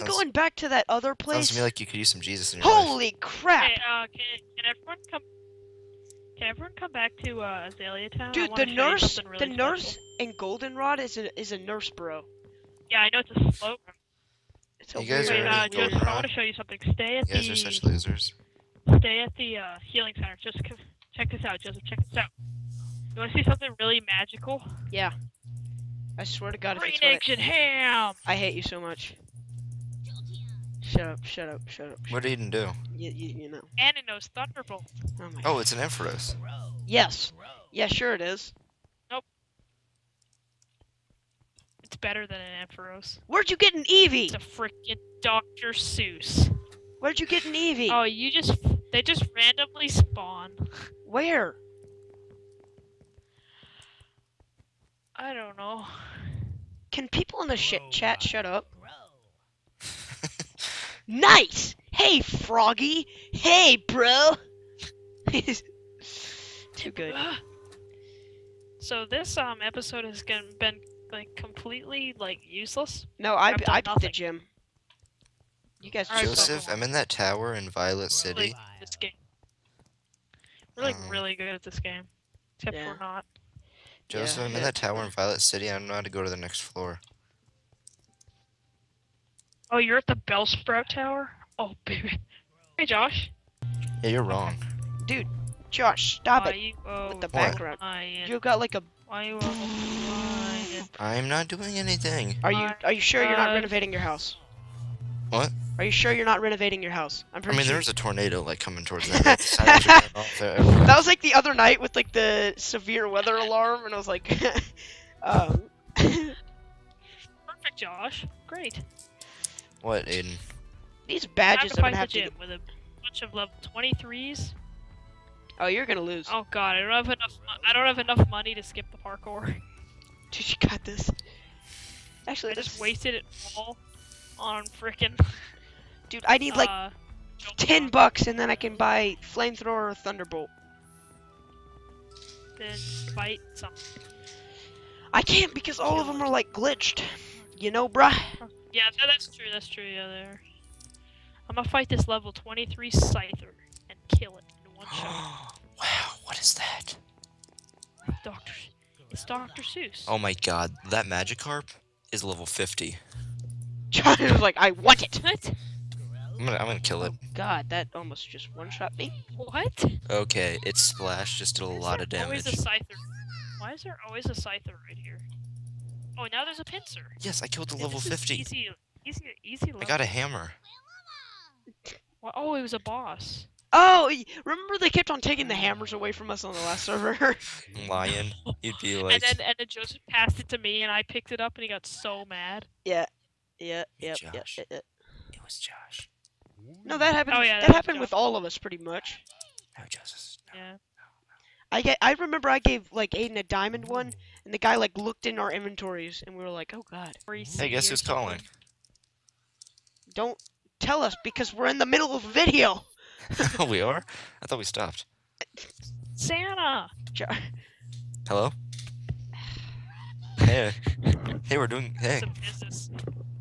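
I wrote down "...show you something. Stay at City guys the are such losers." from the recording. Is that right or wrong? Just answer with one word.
wrong.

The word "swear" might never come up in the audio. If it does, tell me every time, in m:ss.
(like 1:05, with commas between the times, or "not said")
0:26.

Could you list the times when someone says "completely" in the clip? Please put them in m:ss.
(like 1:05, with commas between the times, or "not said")
1:11.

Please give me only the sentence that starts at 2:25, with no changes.
I can't because all of them are like glitched.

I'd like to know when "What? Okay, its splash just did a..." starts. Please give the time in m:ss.
2:49.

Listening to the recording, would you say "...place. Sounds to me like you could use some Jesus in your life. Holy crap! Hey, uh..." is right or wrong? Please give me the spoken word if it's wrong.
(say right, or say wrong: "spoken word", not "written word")
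right.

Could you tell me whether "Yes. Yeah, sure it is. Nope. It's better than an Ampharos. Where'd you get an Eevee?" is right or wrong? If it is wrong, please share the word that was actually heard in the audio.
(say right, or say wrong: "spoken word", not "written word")
right.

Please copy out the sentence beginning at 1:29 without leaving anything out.
Oh, you're at the Bellsprout Tower?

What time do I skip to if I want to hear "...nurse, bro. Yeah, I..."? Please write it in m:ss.
0:11.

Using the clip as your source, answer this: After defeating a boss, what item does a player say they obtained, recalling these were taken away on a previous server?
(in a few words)
A hammer.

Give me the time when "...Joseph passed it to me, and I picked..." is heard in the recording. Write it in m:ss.
3:09.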